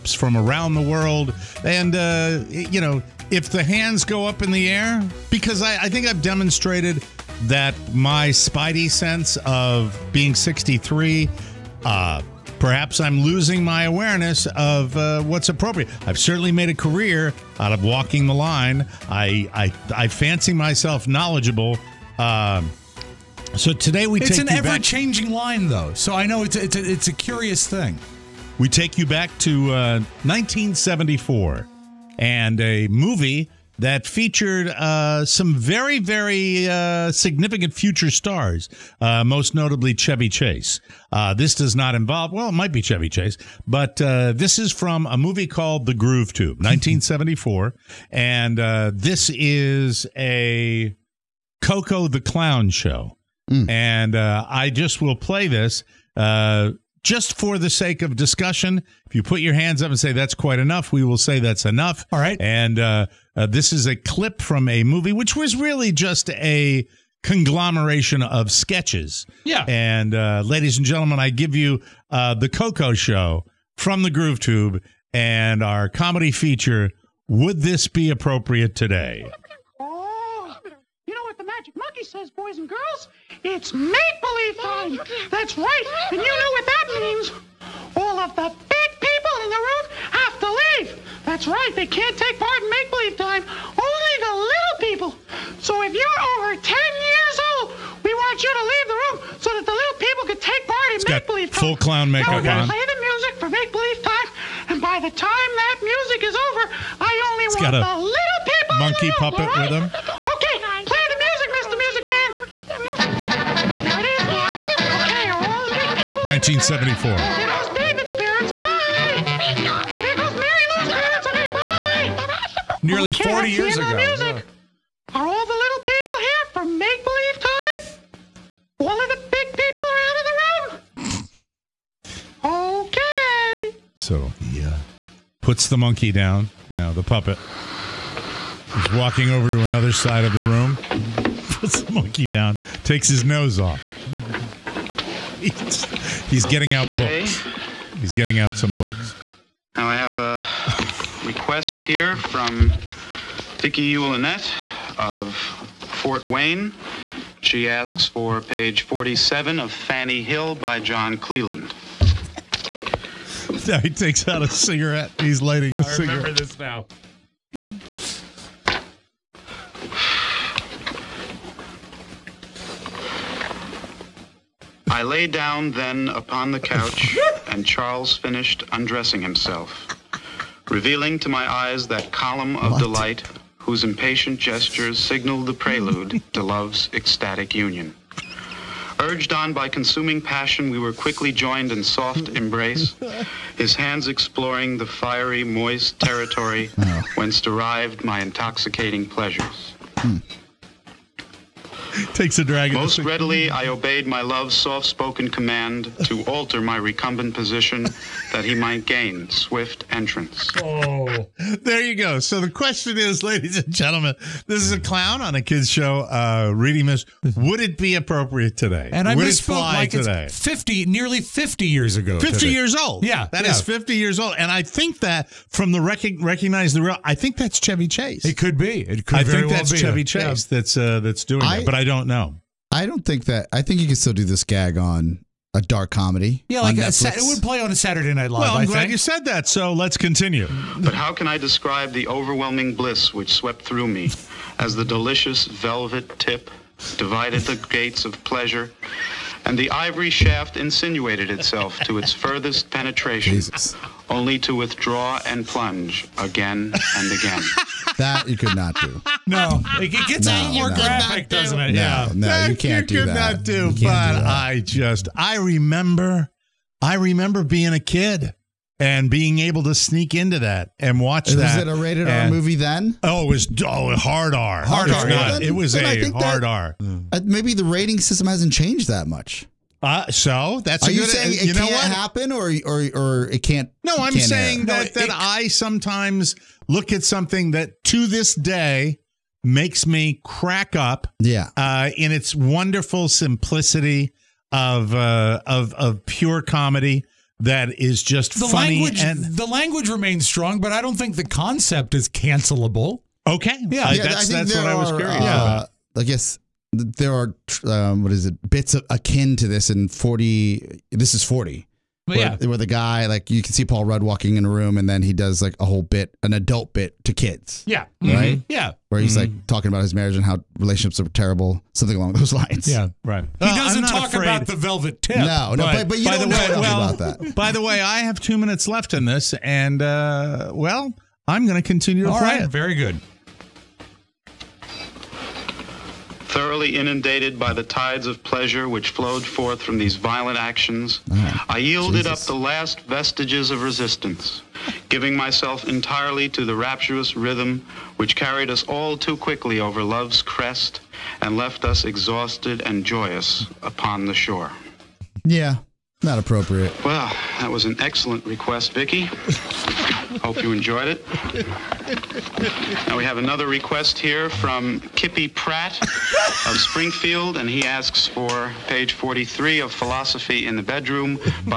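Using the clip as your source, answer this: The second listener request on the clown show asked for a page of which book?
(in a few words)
Philosophy in the Bedroom.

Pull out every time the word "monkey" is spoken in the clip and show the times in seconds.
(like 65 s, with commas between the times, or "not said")
81 s, 108 s, 135 s, 141 s.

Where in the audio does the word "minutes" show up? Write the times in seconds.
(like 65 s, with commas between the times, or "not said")
328 s.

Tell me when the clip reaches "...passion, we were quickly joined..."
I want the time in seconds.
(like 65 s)
190 s.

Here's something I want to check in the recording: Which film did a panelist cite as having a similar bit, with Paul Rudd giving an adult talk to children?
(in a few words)
This Is 40.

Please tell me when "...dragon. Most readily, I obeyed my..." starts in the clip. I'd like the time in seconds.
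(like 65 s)
202 s.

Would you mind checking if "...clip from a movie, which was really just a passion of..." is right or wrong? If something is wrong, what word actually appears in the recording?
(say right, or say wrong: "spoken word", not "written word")
wrong: "conglomeration", not "passion".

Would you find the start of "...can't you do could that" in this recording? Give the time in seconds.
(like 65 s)
262 s.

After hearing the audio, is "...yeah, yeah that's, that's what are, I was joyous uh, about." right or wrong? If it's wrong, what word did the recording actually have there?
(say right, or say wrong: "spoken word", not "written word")
wrong: "curious", not "joyous".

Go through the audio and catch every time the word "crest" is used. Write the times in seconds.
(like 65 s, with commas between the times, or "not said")
350 s.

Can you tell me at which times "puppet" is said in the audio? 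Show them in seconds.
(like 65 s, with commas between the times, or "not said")
109 s, 137 s.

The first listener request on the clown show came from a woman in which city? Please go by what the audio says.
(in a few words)
Fort Wayne.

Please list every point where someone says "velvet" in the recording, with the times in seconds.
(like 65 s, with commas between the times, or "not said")
245 s, 324 s.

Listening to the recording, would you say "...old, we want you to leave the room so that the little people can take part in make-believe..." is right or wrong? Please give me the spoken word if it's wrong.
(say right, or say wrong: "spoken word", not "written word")
right.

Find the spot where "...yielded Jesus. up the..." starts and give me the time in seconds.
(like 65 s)
341 s.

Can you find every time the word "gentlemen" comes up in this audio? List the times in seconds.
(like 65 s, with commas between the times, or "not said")
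70 s, 213 s.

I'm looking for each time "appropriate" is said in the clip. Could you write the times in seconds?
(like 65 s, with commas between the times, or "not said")
15 s, 78 s, 217 s, 356 s.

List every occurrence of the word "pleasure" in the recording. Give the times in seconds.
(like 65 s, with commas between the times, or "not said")
199 s, 248 s, 338 s.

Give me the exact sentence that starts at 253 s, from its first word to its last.
Jesus only to withdraw and plunge again and again.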